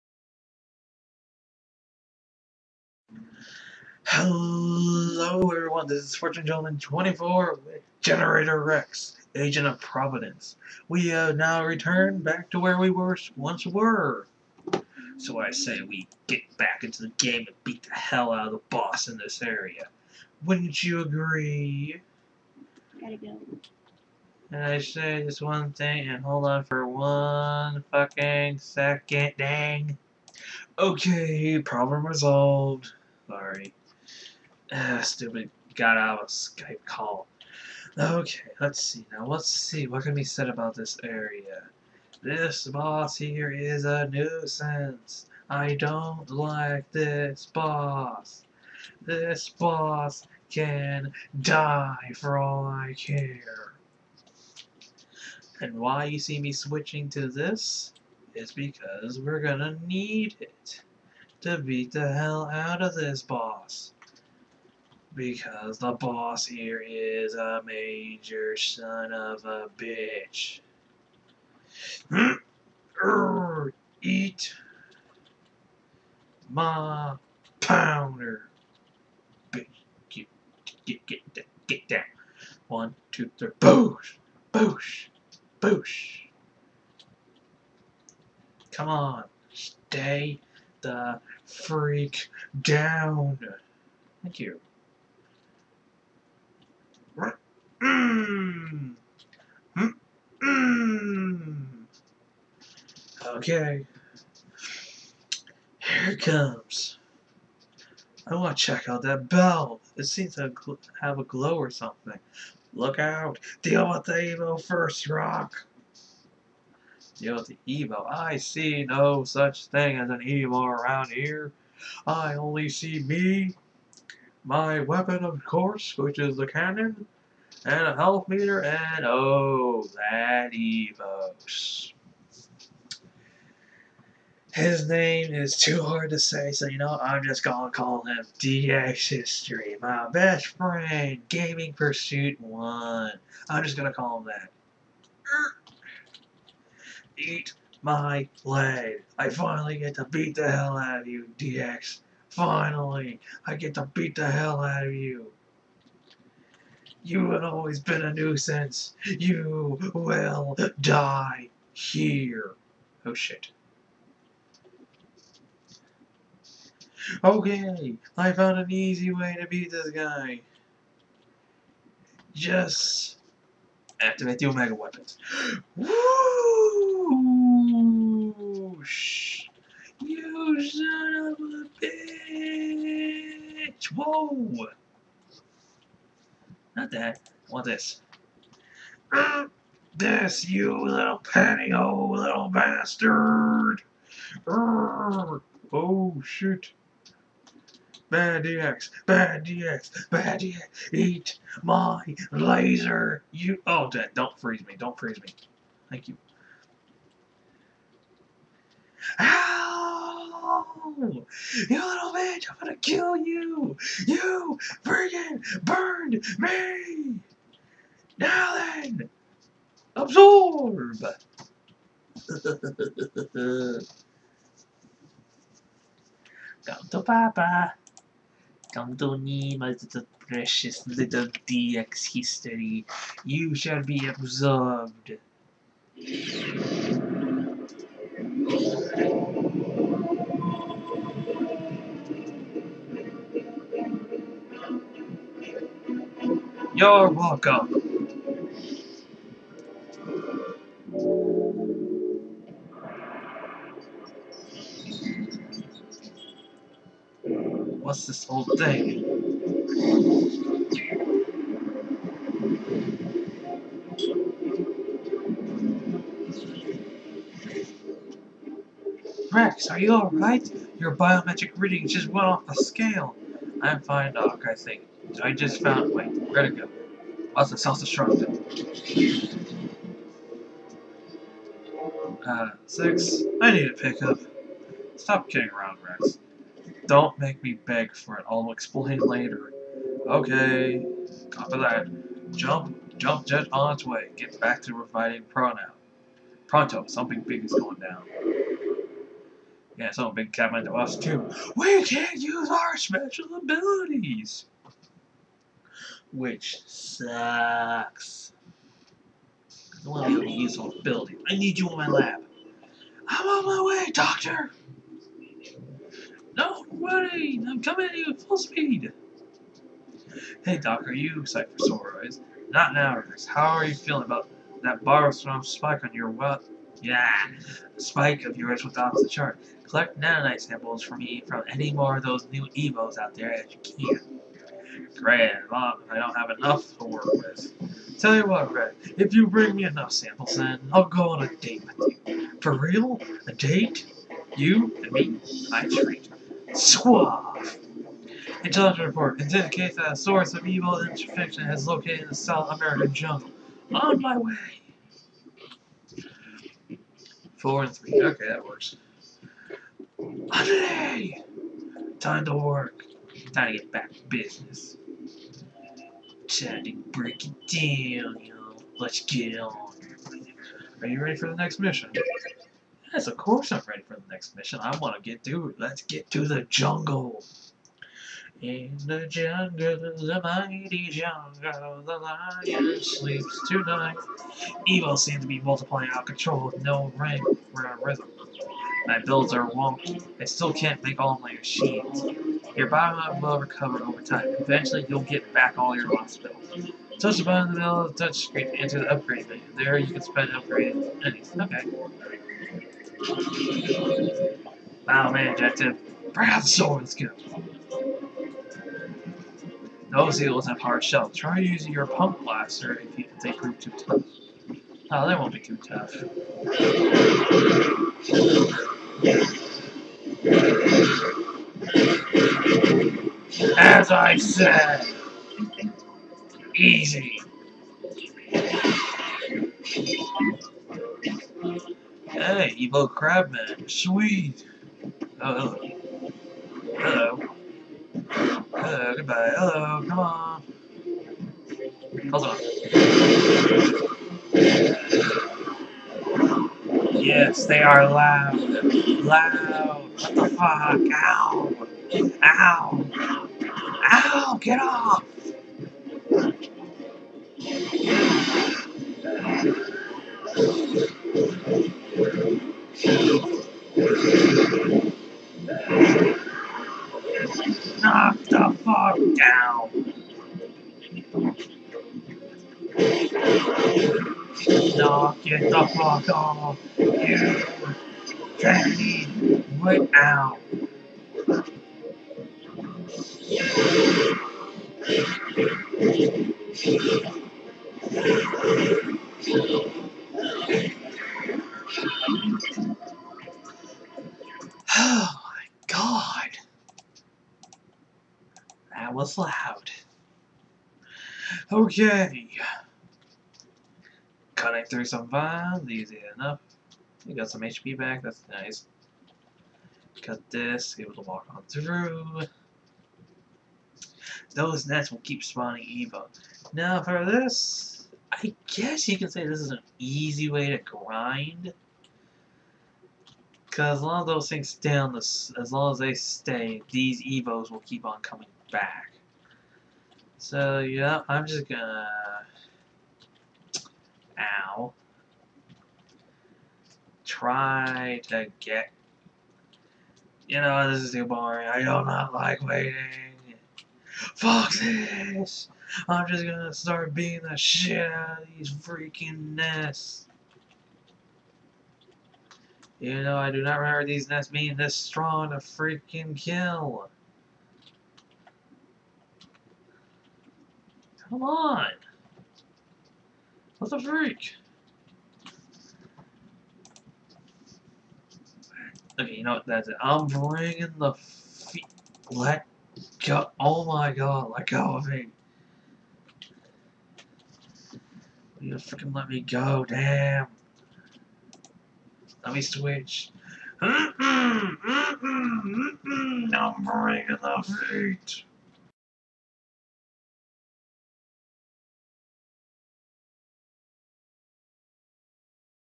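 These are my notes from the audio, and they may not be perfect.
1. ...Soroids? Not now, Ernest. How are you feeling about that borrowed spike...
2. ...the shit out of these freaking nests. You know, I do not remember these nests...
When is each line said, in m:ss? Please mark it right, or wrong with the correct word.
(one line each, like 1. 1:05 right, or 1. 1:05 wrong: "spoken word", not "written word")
1. 5:21 right
2. 9:07 right.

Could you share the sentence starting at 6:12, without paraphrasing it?
Yes, of course I'm ready for the next mission.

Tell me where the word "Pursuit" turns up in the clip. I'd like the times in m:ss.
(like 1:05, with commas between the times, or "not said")
2:21.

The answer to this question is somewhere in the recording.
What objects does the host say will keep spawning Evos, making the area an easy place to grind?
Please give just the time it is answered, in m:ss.
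8:34.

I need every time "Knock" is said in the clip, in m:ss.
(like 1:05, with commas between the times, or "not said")
7:47, 7:54.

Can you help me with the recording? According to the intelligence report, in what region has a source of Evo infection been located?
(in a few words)
South American jungle.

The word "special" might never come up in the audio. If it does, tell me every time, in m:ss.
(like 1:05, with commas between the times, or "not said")
5:02.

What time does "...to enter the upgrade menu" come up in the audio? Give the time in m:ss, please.
6:38.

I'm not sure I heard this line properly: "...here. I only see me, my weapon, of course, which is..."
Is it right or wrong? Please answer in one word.
right.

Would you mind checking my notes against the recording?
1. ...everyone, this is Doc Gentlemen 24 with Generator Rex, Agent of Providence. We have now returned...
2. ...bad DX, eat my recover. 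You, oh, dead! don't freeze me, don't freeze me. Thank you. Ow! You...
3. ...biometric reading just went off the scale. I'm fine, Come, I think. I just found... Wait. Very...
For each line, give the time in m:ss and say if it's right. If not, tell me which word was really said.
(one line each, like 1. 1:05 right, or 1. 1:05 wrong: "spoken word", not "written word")
1. 0:05 wrong: "Fortune", not "Doc"
2. 3:20 wrong: "laser", not "recover"
3. 4:30 wrong: "Doc", not "Come".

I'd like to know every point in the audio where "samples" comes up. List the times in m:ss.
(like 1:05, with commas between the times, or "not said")
5:30, 5:39.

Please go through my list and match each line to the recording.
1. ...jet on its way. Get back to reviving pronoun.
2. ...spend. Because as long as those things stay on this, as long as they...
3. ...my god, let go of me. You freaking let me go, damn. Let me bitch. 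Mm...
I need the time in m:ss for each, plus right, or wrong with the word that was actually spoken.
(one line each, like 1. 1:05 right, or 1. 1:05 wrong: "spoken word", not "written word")
1. 4:53 right
2. 8:40 wrong: "grind", not "spend"
3. 9:33 wrong: "switch", not "bitch".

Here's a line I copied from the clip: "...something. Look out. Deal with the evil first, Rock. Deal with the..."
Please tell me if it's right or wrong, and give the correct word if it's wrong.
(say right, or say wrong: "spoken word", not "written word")
right.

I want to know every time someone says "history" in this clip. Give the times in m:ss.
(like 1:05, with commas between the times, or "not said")
2:19, 3:52.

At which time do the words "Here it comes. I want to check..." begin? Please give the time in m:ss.
1:45.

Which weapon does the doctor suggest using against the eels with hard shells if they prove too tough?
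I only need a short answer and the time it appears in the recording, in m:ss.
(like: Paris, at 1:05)
pump blaster, at 6:51.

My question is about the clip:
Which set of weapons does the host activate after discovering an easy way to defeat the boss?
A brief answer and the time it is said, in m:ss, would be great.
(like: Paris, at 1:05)
Omega weapons, at 2:54.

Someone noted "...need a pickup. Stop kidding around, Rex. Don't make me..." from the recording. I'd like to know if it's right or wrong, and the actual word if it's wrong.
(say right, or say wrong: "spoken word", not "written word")
right.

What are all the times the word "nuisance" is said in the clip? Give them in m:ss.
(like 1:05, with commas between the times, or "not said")
0:44, 2:38.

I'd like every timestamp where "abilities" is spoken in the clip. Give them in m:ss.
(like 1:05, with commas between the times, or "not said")
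5:03.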